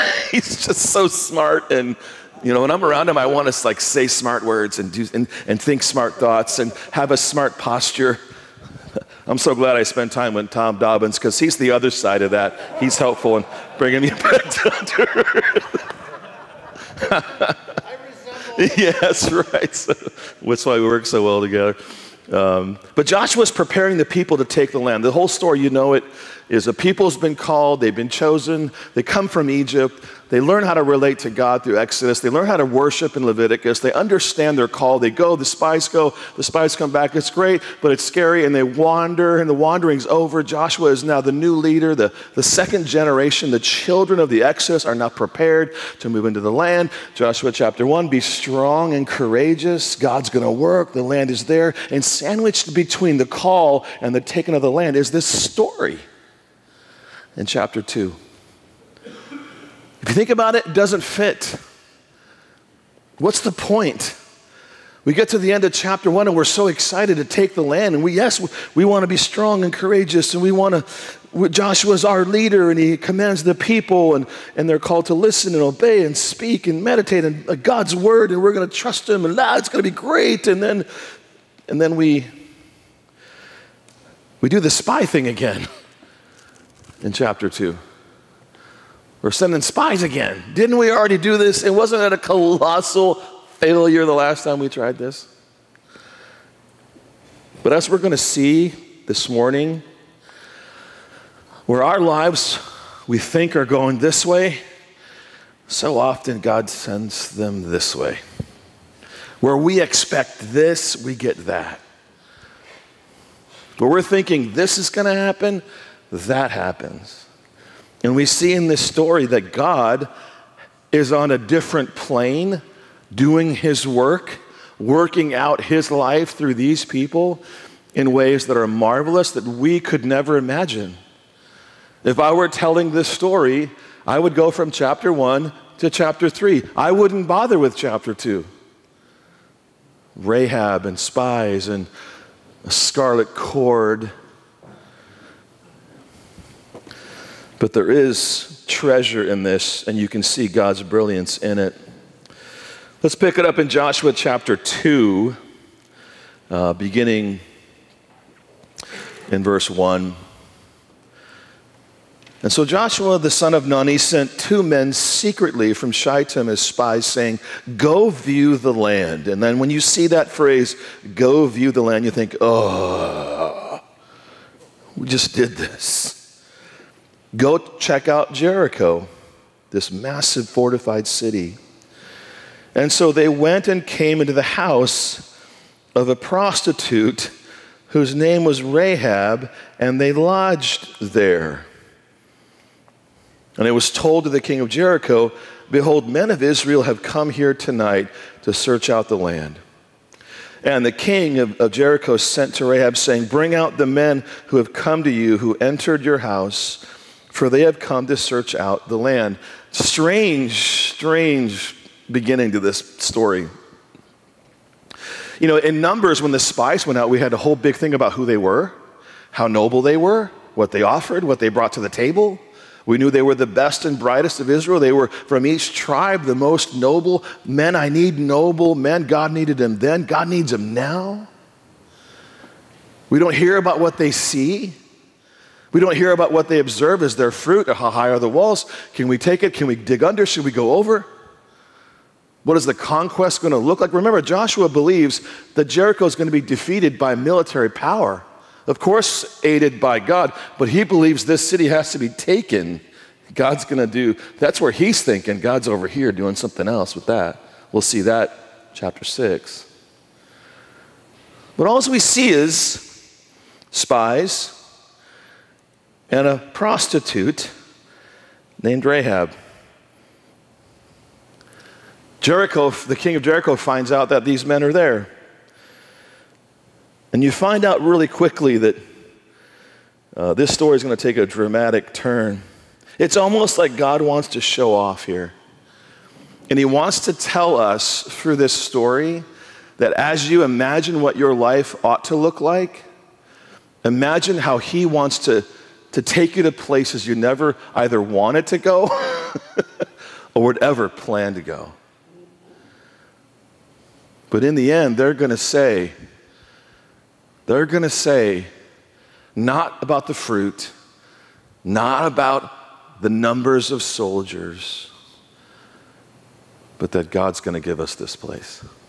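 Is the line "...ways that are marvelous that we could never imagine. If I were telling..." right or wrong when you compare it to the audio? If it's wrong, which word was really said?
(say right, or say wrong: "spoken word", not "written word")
right.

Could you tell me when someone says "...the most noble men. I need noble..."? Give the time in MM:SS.
03:46.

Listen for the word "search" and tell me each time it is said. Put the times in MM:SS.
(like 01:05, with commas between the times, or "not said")
03:18, 03:28.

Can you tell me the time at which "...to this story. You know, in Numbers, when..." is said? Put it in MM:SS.
03:32.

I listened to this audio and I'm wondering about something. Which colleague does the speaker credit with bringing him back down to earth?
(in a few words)
Tom Dobbins.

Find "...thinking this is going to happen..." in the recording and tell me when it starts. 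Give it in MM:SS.
01:54.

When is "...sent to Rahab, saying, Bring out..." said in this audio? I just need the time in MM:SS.
03:22.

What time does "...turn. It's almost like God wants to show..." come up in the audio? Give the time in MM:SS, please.
04:41.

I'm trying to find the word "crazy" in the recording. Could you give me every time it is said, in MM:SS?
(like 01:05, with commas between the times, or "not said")
not said.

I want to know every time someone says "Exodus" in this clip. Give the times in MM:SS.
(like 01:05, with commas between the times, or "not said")
00:31, 00:44.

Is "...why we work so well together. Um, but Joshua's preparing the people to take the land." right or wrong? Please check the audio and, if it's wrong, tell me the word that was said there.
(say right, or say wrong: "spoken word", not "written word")
right.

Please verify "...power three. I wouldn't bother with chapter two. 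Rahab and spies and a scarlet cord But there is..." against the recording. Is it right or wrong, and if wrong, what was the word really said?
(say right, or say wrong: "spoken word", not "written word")
wrong: "chapter", not "power".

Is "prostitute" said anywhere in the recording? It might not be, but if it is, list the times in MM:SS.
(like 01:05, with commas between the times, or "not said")
03:06, 04:26.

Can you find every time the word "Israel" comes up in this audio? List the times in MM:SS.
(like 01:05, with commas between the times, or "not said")
03:16, 03:44.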